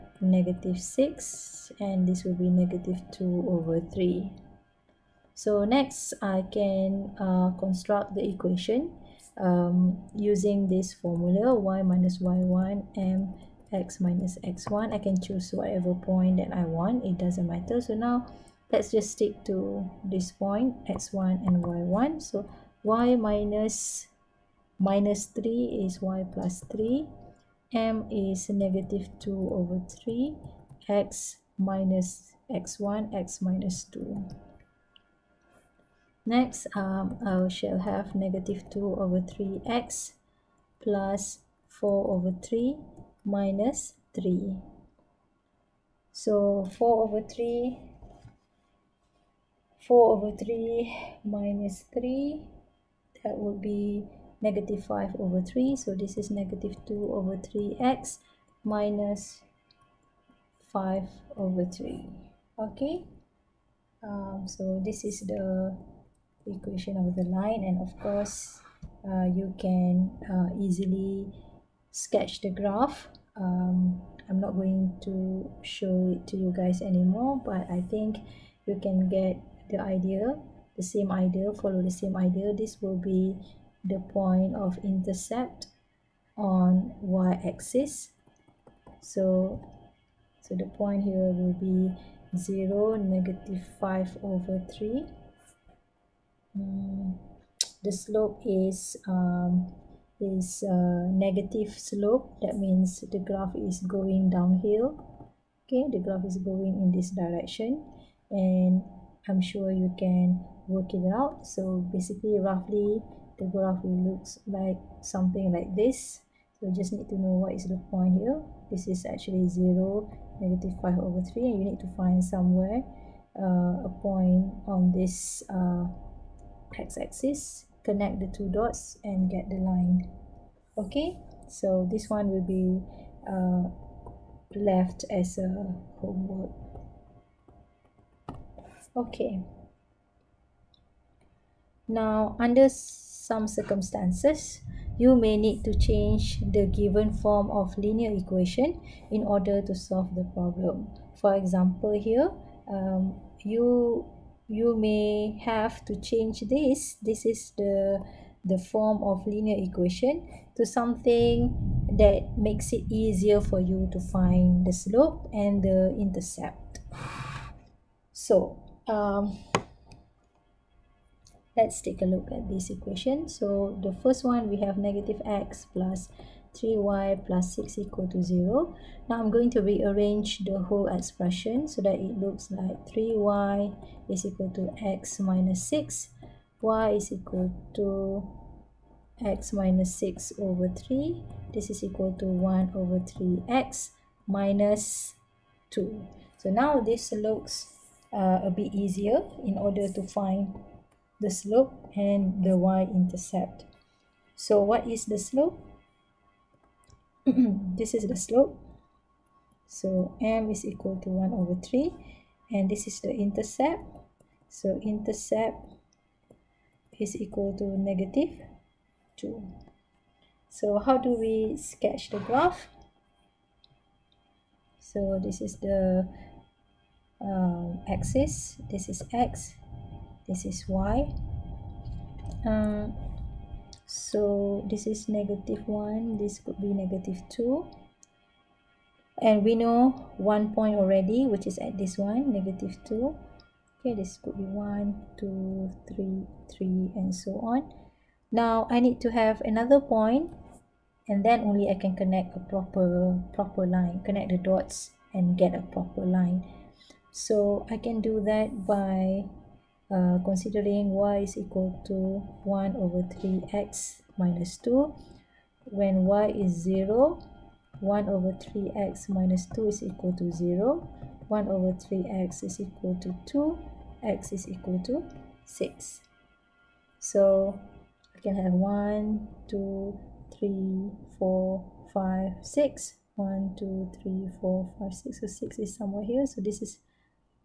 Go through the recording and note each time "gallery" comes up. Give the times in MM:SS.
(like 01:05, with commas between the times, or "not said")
not said.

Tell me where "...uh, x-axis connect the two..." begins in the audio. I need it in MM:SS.
02:05.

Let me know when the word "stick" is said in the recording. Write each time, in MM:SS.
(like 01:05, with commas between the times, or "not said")
00:19.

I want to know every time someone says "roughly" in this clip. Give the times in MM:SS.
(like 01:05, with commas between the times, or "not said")
01:52.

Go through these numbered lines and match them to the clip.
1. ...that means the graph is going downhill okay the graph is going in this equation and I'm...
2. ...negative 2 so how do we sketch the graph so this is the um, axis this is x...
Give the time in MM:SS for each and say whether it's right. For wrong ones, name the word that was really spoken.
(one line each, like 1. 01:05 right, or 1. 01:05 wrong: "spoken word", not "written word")
1. 01:42 wrong: "direction", not "equation"
2. 03:37 right.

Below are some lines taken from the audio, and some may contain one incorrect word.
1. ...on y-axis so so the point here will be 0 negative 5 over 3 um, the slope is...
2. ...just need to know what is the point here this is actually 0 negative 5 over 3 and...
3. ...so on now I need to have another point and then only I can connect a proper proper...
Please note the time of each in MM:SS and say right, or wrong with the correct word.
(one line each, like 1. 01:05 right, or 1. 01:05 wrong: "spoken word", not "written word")
1. 01:26 right
2. 01:56 right
3. 04:07 right.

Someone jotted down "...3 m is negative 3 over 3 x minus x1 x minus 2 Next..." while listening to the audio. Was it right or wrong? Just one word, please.
wrong.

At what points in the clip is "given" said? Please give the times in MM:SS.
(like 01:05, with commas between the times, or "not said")
02:26.